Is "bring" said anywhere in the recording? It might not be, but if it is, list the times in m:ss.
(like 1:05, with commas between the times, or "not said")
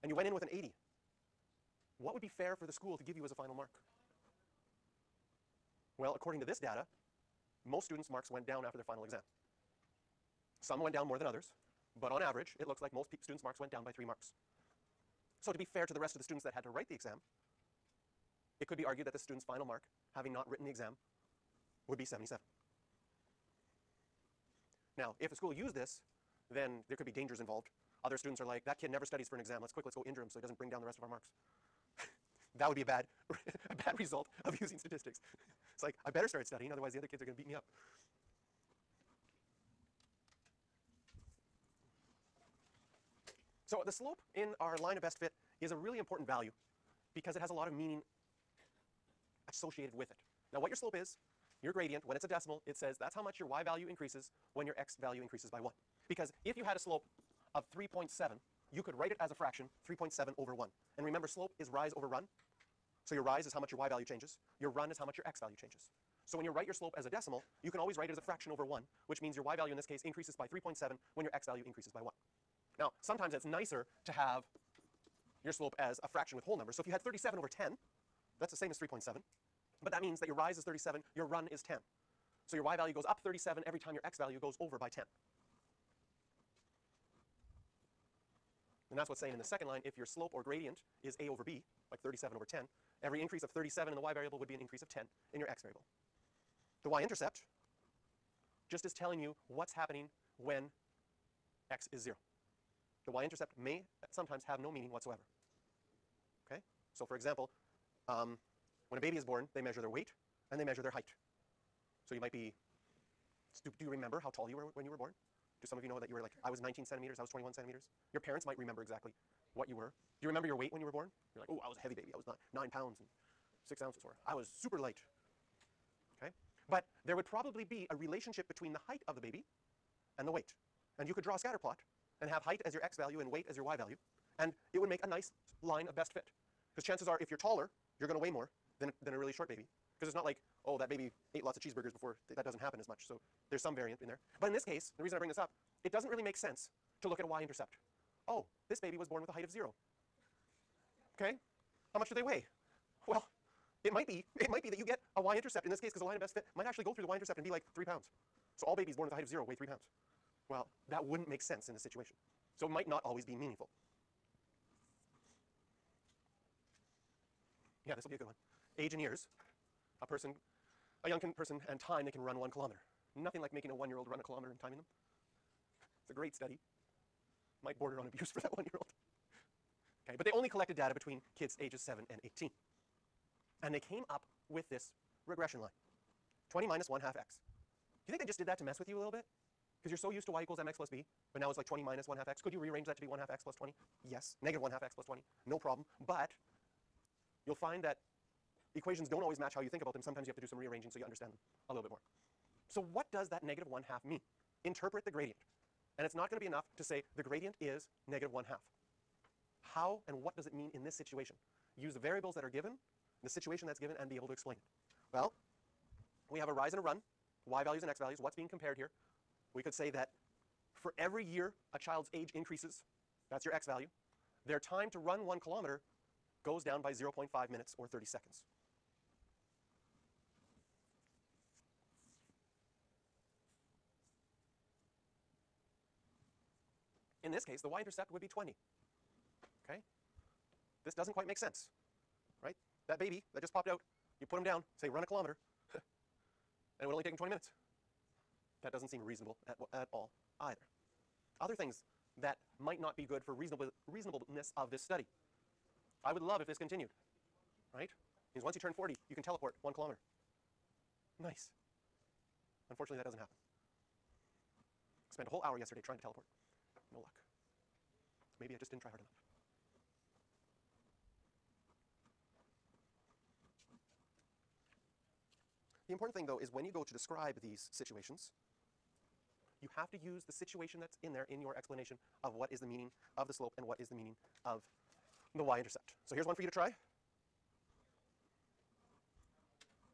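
0:30, 2:25.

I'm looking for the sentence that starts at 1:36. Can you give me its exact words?
The y-intercept just is telling you what's happening when x is 0.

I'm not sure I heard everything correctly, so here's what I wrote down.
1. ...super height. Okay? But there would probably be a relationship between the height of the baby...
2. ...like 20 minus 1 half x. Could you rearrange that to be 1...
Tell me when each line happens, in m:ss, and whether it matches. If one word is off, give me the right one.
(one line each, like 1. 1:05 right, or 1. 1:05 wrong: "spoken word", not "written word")
1. 2:04 wrong: "light", not "height"
2. 3:11 right.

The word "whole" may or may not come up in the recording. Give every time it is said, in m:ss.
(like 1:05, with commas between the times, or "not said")
1:16, 4:25.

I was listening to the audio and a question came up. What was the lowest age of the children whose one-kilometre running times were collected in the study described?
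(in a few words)
7.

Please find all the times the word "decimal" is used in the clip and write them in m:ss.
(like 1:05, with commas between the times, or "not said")
0:52, 1:07.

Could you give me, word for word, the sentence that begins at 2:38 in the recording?
So all babies born with a height of 0 weigh 3 pounds.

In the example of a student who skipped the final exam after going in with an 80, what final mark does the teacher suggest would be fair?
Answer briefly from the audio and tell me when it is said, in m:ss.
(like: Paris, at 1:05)
77, at 0:22.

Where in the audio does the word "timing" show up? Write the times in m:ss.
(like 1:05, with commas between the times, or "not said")
2:54.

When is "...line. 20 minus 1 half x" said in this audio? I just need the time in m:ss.
3:05.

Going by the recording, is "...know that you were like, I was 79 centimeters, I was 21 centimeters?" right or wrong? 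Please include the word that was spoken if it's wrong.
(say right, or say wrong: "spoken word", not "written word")
wrong: "19", not "79".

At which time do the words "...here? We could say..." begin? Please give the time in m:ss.
3:38.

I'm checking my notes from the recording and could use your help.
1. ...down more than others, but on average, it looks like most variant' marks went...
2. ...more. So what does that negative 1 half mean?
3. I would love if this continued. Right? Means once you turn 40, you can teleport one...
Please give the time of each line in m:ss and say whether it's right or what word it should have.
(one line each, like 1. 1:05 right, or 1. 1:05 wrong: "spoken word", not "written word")
1. 0:10 wrong: "students", not "variant"
2. 3:21 right
3. 4:16 right.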